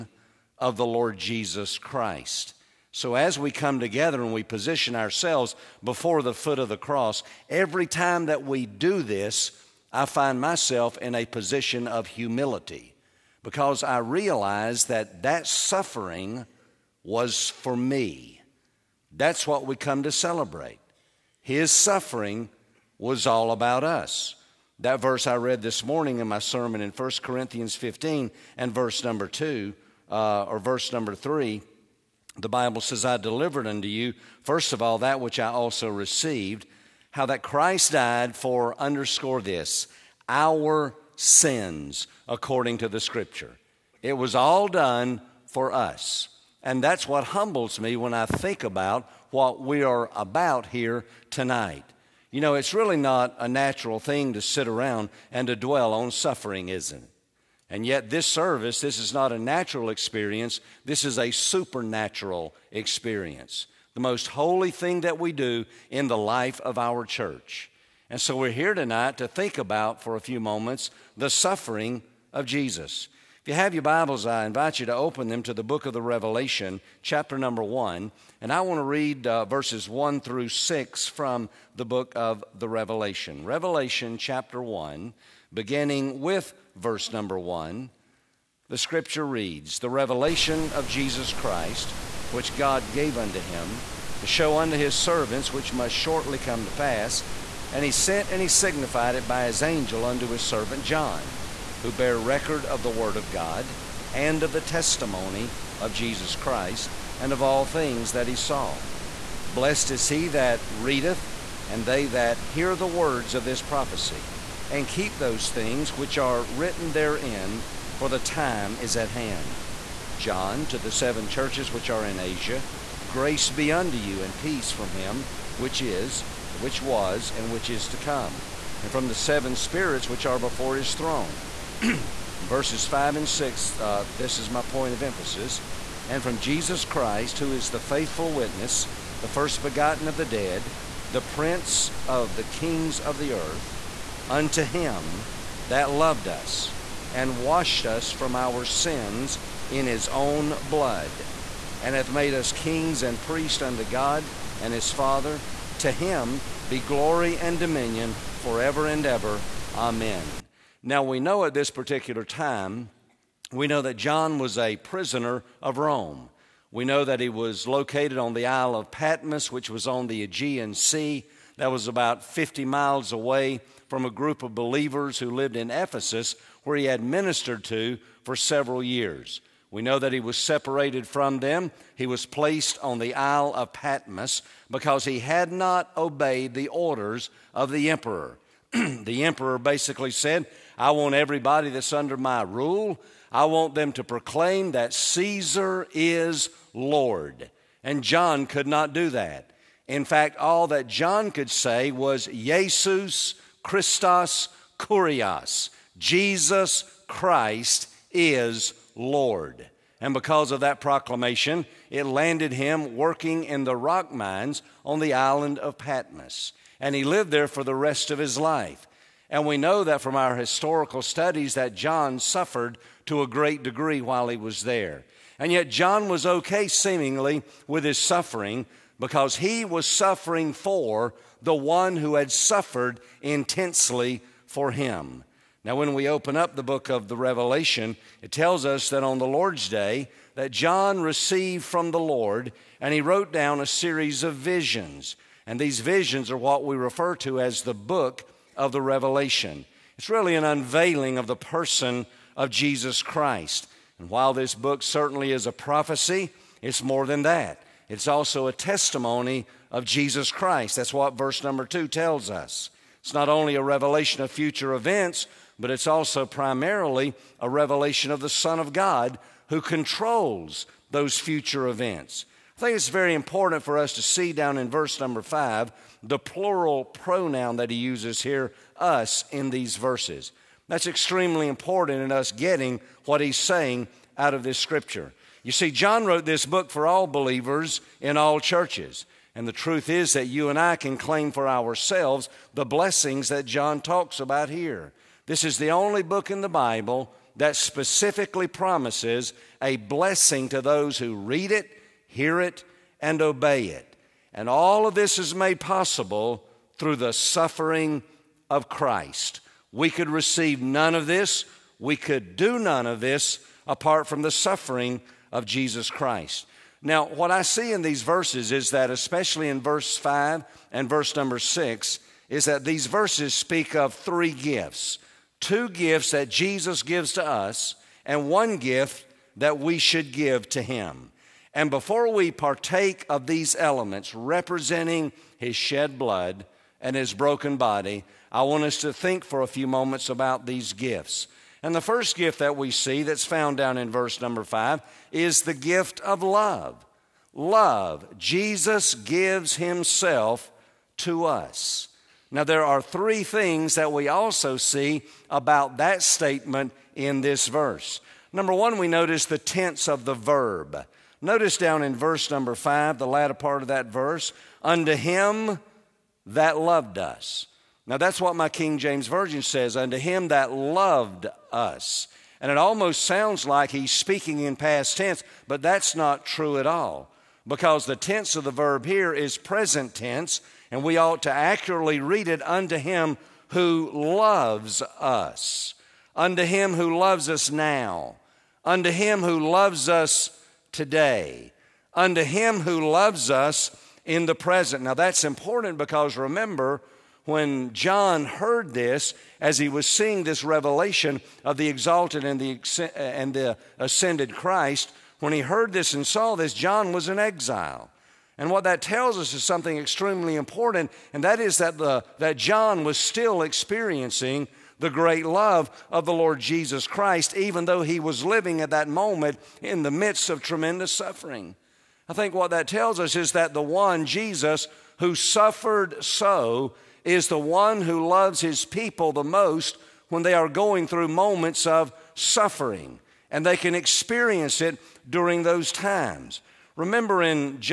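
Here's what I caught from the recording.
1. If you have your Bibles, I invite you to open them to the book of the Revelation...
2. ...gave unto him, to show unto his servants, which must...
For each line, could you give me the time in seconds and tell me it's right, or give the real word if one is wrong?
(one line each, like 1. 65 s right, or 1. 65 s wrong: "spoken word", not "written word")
1. 73 s right
2. 92 s right.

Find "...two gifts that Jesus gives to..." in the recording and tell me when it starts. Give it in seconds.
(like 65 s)
325 s.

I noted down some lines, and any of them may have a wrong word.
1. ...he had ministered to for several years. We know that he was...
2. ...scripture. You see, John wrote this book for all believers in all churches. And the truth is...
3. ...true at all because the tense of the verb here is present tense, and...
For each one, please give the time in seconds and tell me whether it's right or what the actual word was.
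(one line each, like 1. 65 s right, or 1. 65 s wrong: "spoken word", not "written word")
1. 176 s right
2. 284 s right
3. 376 s right.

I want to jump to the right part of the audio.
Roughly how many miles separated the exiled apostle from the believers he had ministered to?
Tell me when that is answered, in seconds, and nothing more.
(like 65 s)
172 s.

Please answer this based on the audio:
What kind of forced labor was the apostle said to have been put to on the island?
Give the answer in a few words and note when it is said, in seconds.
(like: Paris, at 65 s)
Working in the rock mines, at 212 s.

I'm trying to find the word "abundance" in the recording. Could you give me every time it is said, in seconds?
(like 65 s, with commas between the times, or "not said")
not said.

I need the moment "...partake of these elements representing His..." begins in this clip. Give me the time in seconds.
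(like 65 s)
332 s.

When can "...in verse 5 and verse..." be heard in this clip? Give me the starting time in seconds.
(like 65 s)
319 s.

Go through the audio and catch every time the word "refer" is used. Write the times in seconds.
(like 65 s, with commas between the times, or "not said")
246 s.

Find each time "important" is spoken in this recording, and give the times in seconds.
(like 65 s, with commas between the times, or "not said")
273 s, 281 s, 395 s, 410 s.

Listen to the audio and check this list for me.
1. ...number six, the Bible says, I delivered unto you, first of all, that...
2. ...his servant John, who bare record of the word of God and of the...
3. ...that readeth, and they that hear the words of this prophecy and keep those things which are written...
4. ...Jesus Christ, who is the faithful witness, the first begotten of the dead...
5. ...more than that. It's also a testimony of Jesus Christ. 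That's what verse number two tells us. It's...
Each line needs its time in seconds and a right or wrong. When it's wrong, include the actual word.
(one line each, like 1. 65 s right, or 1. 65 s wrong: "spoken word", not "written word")
1. 30 s wrong: "three", not "six"
2. 100 s right
3. 110 s right
4. 136 s right
5. 256 s right.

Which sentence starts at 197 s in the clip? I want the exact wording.
And John could not do that.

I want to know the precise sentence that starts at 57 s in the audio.
And yet, this service, this is not a natural experience, this is a supernatural experience.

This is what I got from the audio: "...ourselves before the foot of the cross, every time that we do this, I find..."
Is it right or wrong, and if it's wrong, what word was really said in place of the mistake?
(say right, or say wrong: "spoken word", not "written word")
right.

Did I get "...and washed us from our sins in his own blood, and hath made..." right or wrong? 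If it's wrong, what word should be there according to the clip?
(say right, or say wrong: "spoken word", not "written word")
right.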